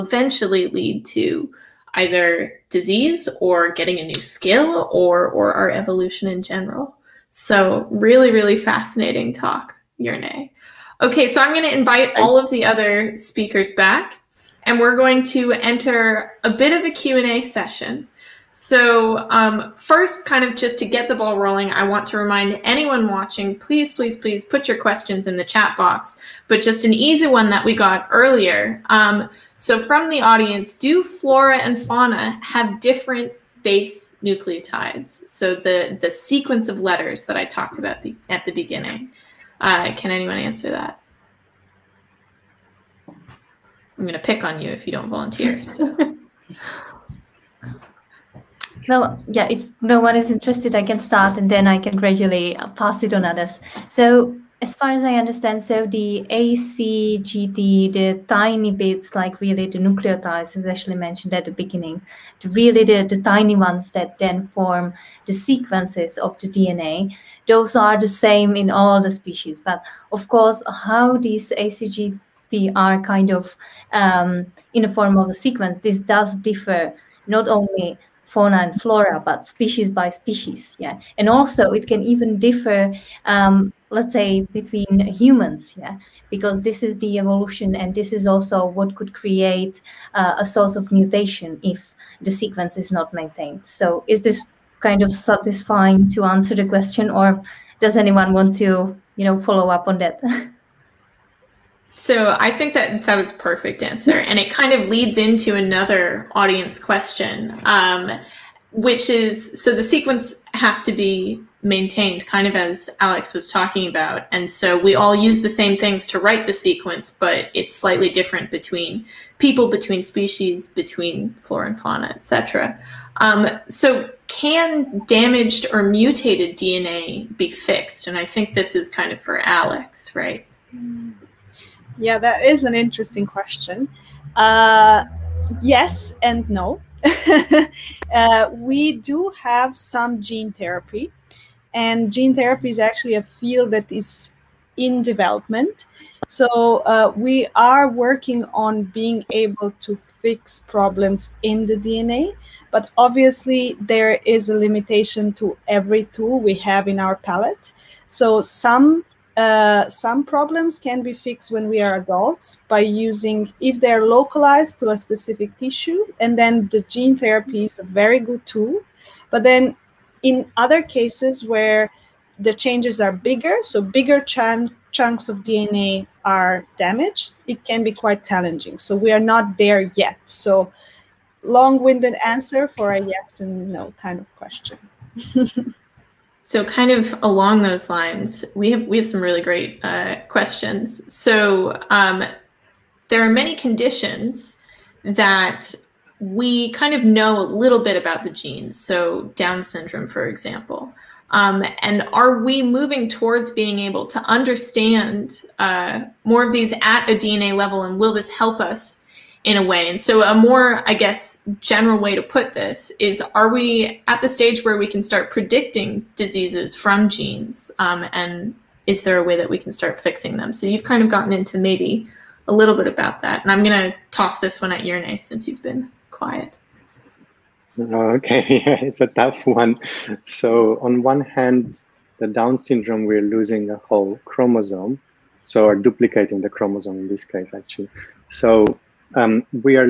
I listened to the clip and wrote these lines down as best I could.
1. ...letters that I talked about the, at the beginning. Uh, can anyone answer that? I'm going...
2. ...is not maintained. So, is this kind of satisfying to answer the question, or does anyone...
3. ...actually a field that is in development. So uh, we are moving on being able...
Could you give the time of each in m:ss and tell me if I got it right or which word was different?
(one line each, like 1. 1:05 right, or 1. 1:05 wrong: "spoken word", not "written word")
1. 0:36 right
2. 1:32 right
3. 2:22 wrong: "working", not "moving".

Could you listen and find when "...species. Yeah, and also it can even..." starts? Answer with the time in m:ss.
1:20.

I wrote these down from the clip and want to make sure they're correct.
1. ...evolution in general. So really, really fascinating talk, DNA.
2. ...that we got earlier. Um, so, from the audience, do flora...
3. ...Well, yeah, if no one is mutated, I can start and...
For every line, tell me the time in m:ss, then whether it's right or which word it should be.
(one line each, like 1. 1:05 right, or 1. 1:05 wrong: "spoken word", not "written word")
1. 0:05 wrong: "Jernej", not "DNA"
2. 0:27 right
3. 0:48 wrong: "interested", not "mutated".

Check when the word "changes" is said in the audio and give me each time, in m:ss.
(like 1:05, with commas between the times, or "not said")
2:52.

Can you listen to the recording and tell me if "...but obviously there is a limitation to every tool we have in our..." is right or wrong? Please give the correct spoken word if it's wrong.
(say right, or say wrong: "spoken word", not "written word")
right.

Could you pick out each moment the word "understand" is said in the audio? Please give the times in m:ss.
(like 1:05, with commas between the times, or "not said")
0:55, 3:24.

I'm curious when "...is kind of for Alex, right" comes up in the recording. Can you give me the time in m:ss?
2:08.